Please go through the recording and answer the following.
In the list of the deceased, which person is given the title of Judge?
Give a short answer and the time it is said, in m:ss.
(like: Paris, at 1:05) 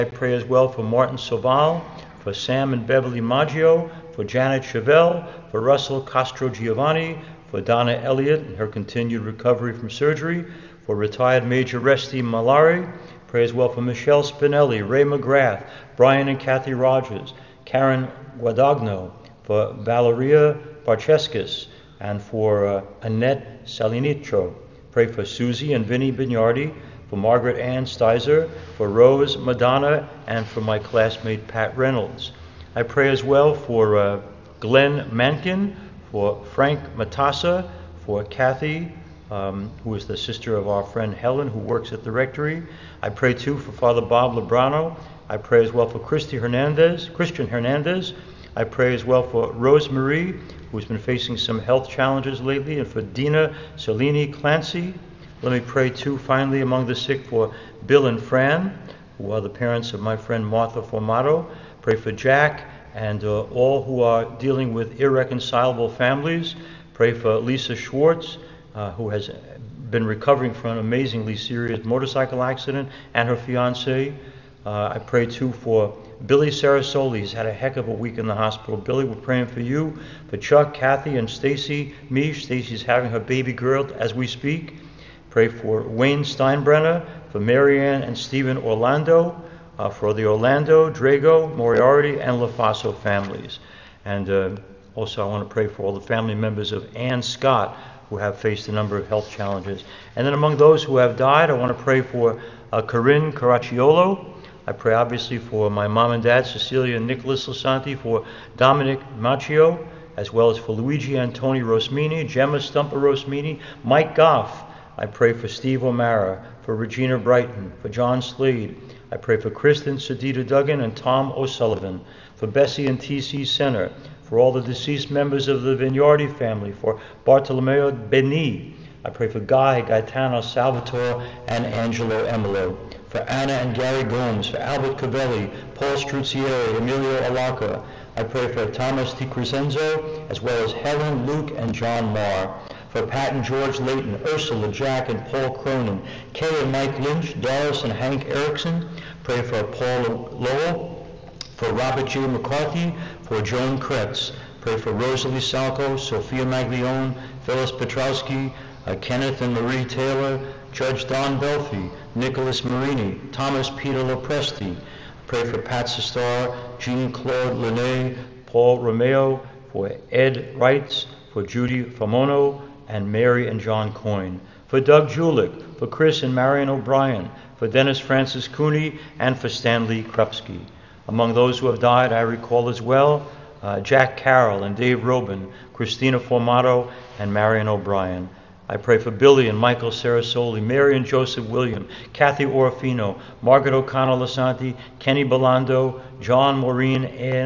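Don Belfi, at 2:41.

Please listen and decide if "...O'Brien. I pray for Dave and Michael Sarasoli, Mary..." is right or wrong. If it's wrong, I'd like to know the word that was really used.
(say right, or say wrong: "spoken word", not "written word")
wrong: "Billy", not "Dave".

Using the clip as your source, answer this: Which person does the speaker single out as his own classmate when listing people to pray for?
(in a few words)
Pat Reynolds.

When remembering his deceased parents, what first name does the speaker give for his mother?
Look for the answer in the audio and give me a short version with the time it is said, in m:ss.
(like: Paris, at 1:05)
Cecilia, at 1:46.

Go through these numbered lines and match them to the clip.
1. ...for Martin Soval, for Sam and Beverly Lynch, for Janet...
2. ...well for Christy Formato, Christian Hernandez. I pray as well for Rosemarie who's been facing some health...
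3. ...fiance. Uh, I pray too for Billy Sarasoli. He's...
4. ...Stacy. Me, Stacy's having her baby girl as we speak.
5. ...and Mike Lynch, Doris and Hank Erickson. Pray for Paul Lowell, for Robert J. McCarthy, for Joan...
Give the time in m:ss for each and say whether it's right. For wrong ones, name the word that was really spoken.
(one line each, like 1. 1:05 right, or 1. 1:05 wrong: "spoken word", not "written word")
1. 0:00 wrong: "Maggio", not "Lynch"
2. 0:45 wrong: "Hernandez", not "Formato"
3. 1:13 right
4. 1:21 right
5. 2:26 right.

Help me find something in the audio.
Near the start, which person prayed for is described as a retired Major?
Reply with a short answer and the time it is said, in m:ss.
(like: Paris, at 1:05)
Resty Malari, at 0:11.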